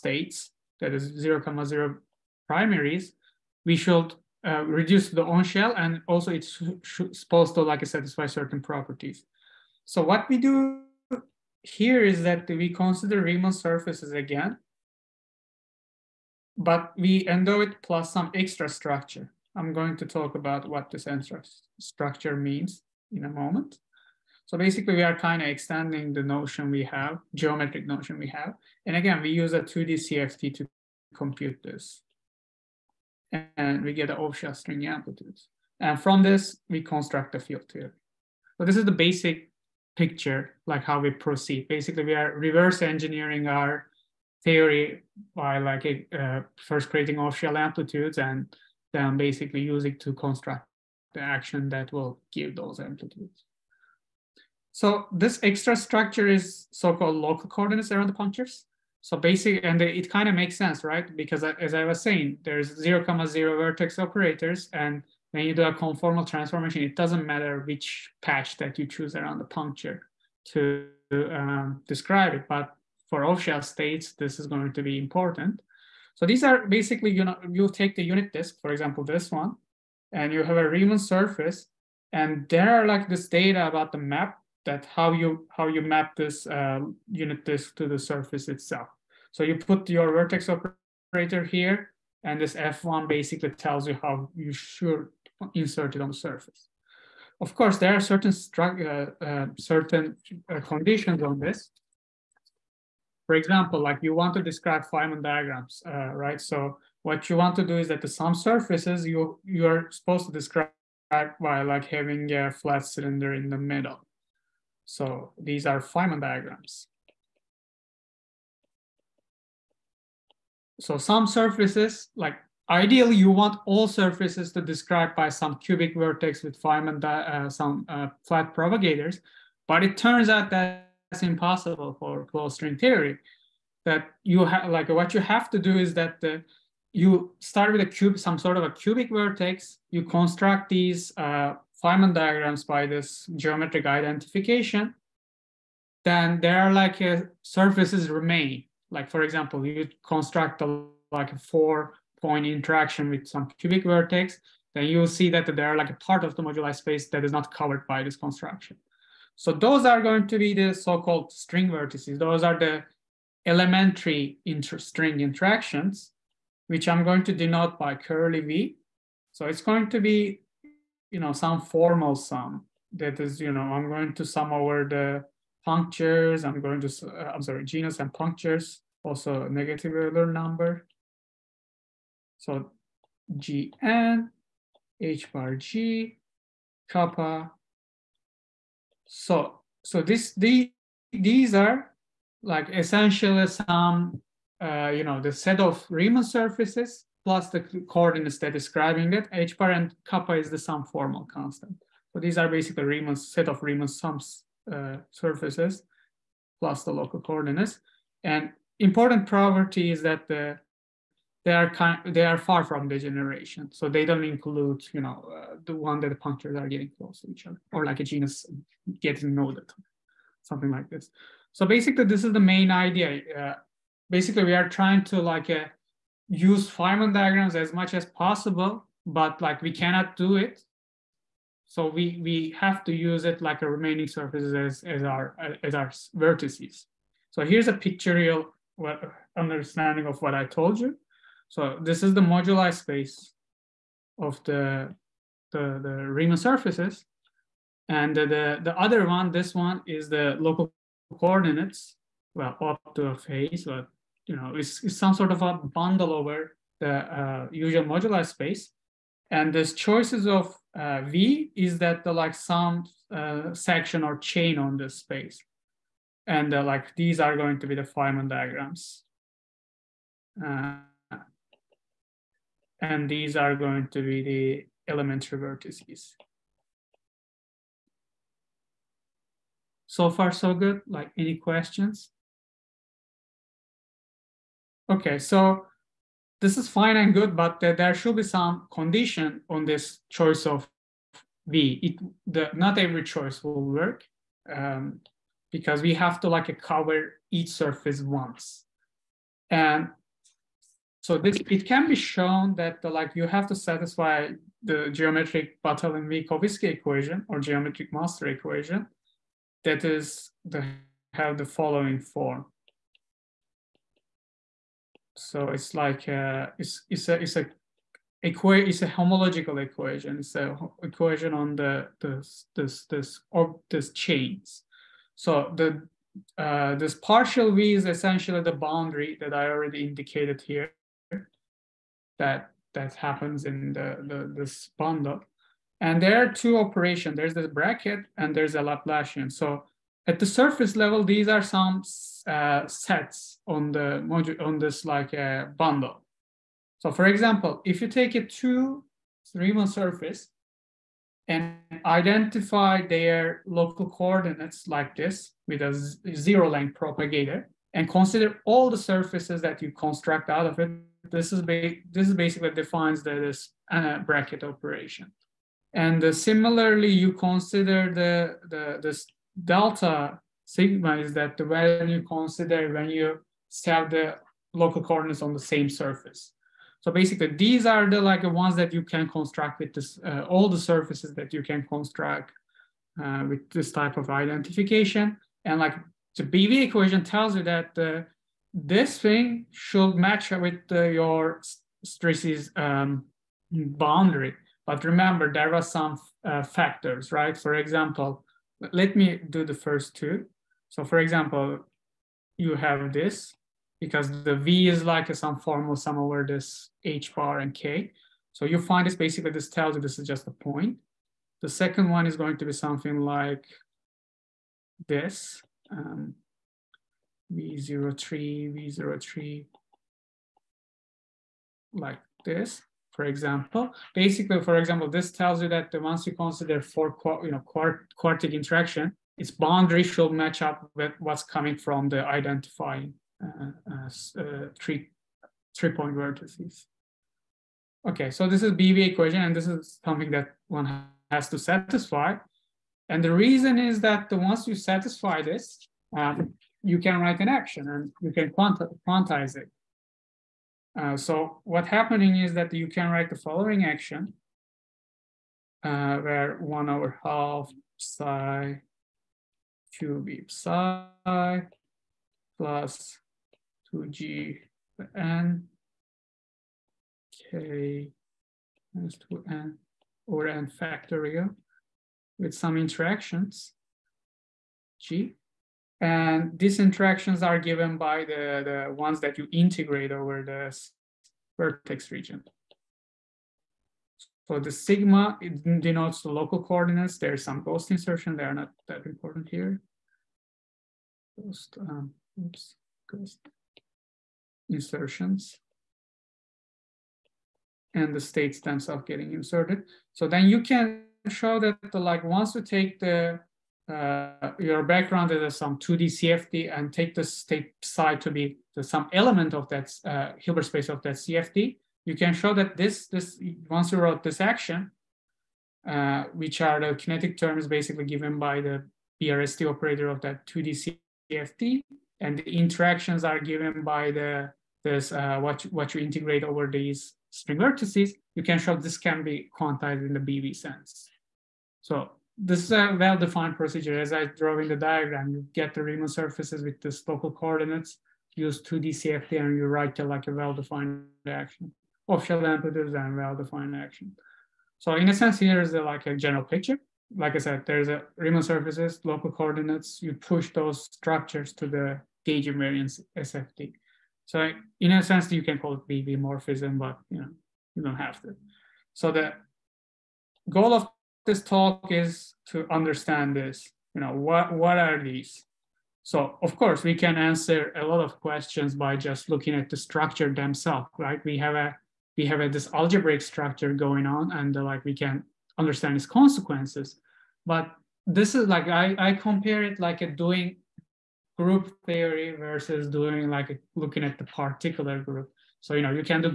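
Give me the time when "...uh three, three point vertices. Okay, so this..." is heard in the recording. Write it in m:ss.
7:14.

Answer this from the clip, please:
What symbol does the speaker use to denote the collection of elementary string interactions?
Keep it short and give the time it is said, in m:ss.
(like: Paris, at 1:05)
Curly V, at 2:47.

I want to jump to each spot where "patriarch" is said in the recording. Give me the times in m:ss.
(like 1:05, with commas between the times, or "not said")
not said.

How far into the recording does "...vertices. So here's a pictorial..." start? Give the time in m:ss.
3:56.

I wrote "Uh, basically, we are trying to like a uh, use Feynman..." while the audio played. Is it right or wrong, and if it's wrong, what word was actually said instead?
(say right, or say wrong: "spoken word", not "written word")
right.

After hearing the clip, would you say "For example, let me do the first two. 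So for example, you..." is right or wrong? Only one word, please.
right.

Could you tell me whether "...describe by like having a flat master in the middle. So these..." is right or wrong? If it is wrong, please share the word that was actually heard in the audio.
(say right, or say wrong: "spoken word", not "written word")
wrong: "cylinder", not "master".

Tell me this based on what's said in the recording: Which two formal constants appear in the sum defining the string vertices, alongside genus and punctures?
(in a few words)
H bar and kappa.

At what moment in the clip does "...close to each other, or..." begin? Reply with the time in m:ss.
3:36.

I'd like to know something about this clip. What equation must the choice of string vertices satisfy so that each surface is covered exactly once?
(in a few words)
Geometric Batalin-Vilkovisky equation.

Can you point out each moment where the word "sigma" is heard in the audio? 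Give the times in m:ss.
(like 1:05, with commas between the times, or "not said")
6:10, 8:04.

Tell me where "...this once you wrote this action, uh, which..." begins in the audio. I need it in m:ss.
8:32.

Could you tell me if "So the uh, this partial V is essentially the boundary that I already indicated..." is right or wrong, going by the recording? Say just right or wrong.
right.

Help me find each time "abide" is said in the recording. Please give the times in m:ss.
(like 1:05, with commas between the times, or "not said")
not said.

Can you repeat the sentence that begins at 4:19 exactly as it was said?
And this choices of uh, V is that the like some uh, section or chain on this space.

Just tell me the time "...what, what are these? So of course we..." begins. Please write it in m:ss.
9:23.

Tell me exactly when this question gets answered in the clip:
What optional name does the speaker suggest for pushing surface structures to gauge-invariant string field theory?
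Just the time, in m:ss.
9:15.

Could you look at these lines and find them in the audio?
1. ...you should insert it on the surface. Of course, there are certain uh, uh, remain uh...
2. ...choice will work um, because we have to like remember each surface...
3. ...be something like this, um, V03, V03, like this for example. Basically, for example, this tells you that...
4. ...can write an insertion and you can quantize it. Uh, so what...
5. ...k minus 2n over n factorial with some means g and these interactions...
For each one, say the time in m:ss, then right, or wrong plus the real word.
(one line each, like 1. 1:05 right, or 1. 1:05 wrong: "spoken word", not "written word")
1. 1:34 wrong: "certain", not "remain"
2. 4:53 wrong: "cover", not "remember"
3. 6:52 right
4. 7:26 wrong: "action", not "insertion"
5. 7:47 wrong: "interactions", not "means".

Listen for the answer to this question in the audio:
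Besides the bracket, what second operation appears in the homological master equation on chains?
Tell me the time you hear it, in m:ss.
5:38.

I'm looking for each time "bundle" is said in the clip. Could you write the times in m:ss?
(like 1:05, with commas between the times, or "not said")
4:15, 5:34, 5:45.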